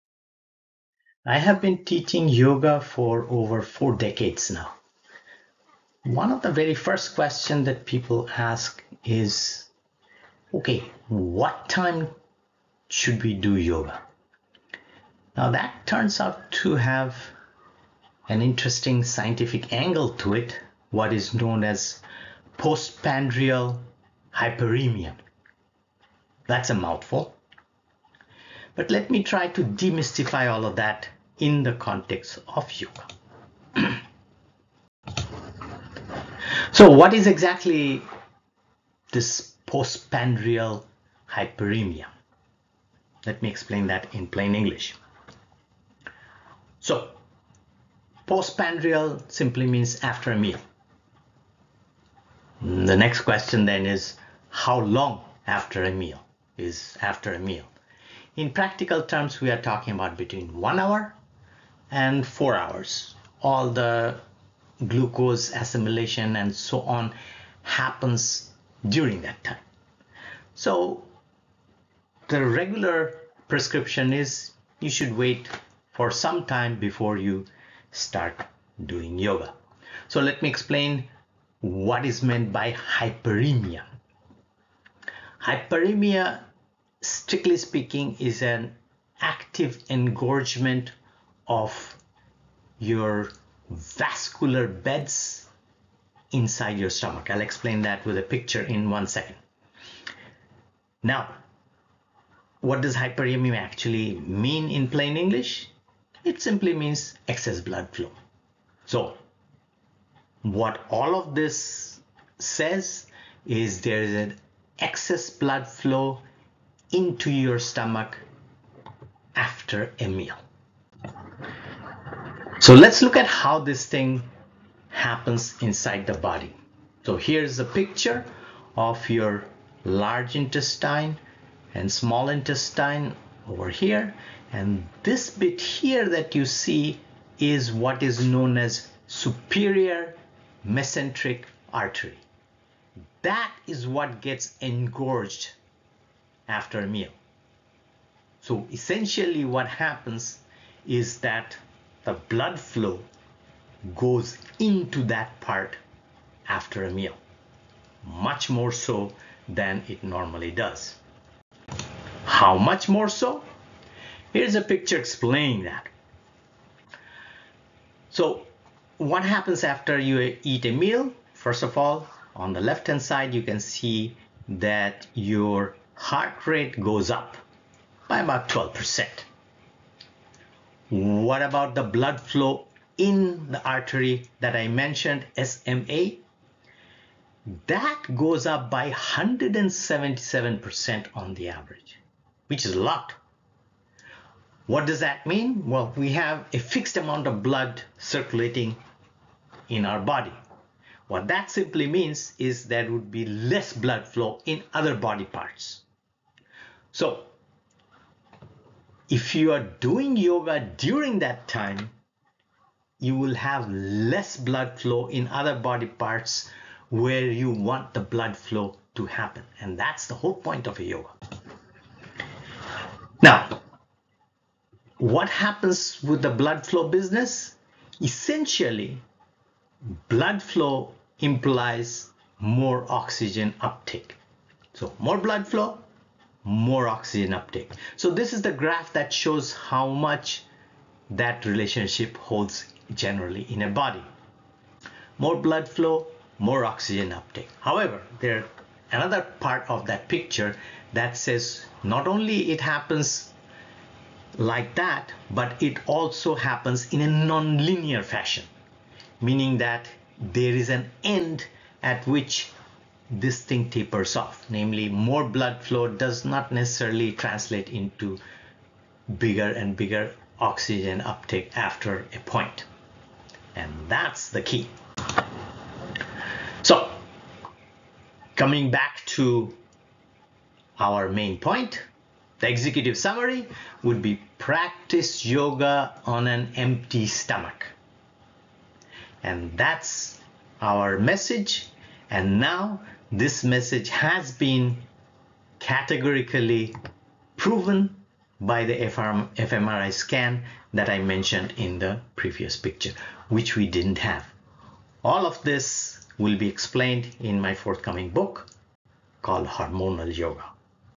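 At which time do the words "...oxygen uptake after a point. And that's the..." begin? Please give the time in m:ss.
4:30.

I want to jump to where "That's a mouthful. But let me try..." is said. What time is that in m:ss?
0:26.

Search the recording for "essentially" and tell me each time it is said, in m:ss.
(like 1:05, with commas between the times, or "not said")
2:28, 3:48.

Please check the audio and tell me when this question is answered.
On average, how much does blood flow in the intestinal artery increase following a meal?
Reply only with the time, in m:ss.
3:08.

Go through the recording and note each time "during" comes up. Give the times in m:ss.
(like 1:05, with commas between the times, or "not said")
1:08, 3:30.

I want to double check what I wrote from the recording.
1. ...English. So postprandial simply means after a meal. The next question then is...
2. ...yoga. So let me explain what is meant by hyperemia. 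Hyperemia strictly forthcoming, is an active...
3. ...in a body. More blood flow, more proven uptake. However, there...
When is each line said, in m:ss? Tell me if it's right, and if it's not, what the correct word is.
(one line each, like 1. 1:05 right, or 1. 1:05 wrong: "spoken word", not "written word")
1. 0:44 right
2. 1:19 wrong: "speaking", not "forthcoming"
3. 4:03 wrong: "oxygen", not "proven".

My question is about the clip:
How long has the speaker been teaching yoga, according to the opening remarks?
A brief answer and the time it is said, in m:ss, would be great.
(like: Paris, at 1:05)
over four decades, at 0:03.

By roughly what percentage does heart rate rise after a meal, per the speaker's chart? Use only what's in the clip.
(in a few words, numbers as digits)
12%.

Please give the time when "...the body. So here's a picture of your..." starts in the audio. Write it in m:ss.
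2:06.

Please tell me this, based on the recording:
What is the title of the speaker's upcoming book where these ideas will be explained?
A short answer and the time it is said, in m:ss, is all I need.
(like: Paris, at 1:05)
Hormonal Yoga, at 5:09.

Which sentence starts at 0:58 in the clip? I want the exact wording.
In practical terms, we are talking about between one hour and four hours.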